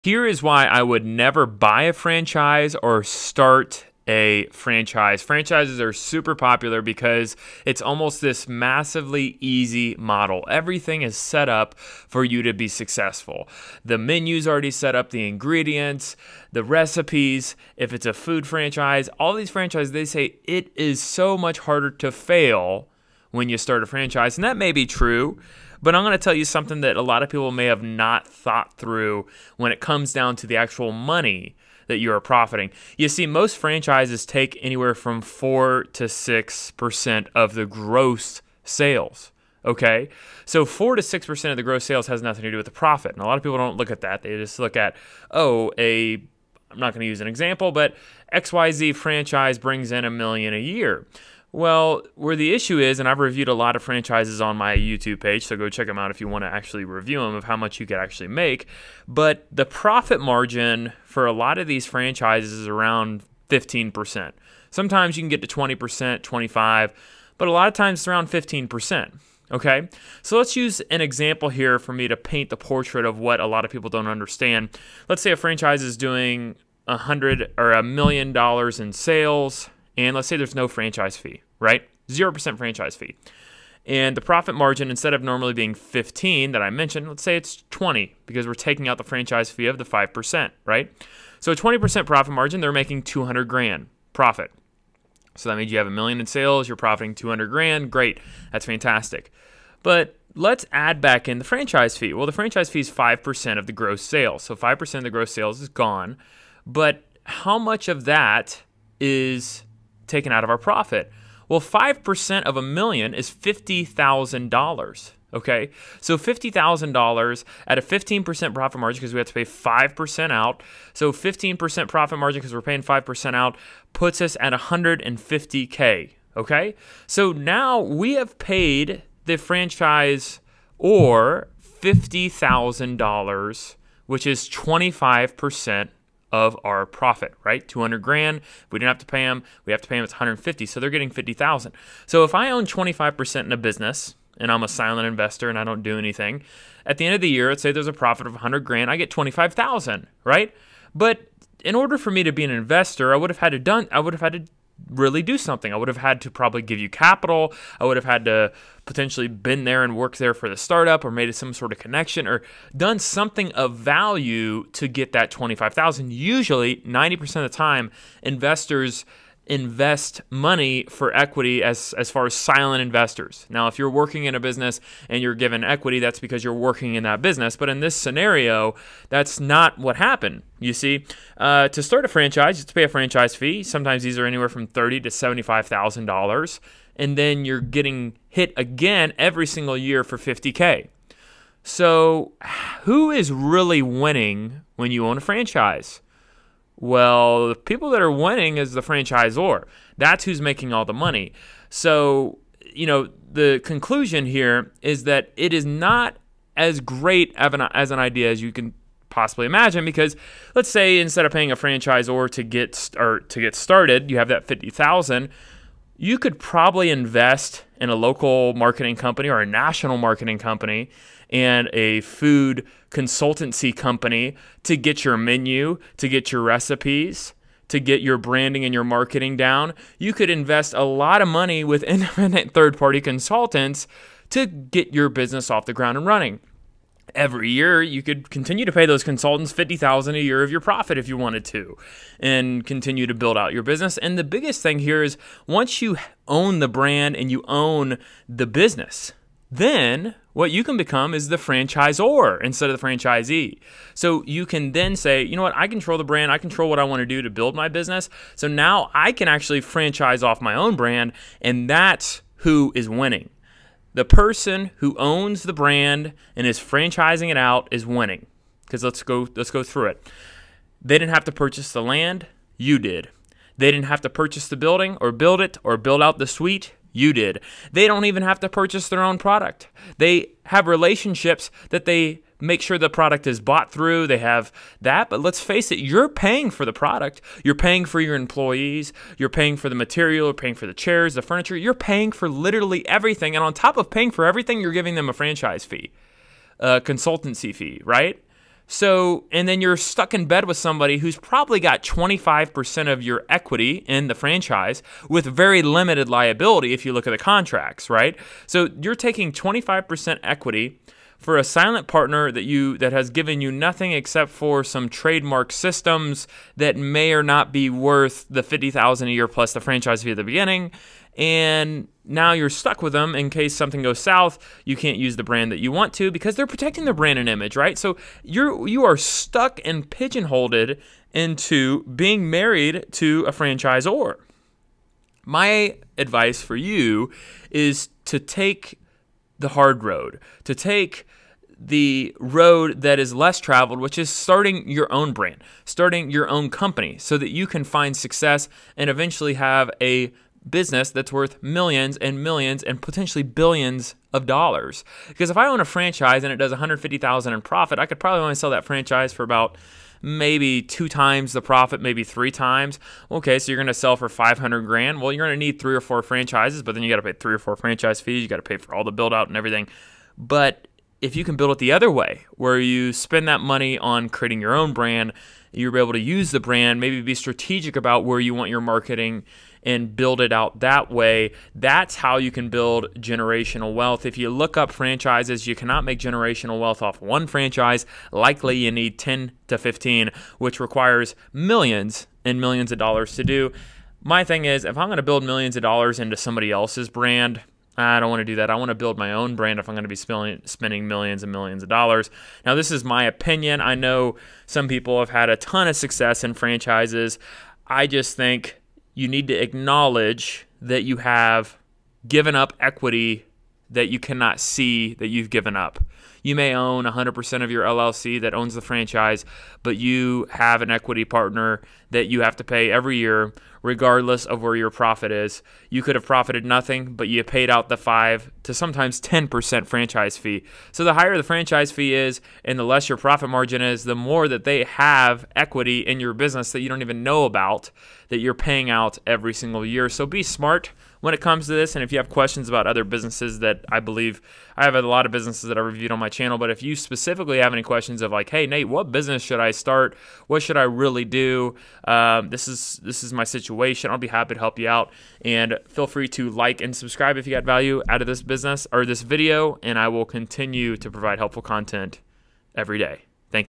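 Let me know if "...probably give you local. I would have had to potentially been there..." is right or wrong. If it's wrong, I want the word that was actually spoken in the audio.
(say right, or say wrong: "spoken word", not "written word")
wrong: "capital", not "local".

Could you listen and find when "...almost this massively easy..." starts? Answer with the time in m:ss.
0:07.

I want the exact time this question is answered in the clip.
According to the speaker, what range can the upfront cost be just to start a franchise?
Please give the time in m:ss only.
3:04.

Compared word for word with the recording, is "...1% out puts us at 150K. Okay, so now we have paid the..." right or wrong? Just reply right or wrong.
wrong.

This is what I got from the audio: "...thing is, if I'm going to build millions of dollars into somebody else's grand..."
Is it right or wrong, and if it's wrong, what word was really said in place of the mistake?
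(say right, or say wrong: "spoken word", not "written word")
wrong: "brand", not "grand".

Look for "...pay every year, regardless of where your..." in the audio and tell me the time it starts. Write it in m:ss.
7:02.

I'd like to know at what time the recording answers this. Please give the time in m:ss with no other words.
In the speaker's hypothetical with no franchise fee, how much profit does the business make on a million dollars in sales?
1:33.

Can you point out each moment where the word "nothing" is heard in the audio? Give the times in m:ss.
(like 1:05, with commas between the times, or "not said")
0:42, 5:13, 7:06.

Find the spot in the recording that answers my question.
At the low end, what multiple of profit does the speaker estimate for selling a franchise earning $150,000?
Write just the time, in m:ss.
6:00.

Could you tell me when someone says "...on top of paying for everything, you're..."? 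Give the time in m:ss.
4:53.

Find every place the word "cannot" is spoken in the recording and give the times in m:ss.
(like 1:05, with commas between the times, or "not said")
6:25, 6:53.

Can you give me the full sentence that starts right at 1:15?
Let's say a franchise is doing a hundred or a million dollars in sales and let's say there's no franchise fee, right?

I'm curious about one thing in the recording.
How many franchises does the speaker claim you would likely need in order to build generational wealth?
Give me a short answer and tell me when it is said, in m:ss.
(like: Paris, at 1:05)
10 to 15, at 6:28.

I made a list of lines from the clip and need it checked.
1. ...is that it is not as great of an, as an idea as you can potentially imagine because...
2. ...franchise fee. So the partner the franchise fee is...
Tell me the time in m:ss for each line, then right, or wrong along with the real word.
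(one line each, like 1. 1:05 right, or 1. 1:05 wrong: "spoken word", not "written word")
1. 3:24 wrong: "possibly", not "potentially"
2. 7:09 wrong: "higher", not "partner".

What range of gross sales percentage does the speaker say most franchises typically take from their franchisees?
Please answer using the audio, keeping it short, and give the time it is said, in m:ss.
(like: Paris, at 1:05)
4 to 6%, at 0:35.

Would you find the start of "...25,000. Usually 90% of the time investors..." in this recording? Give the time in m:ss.
2:45.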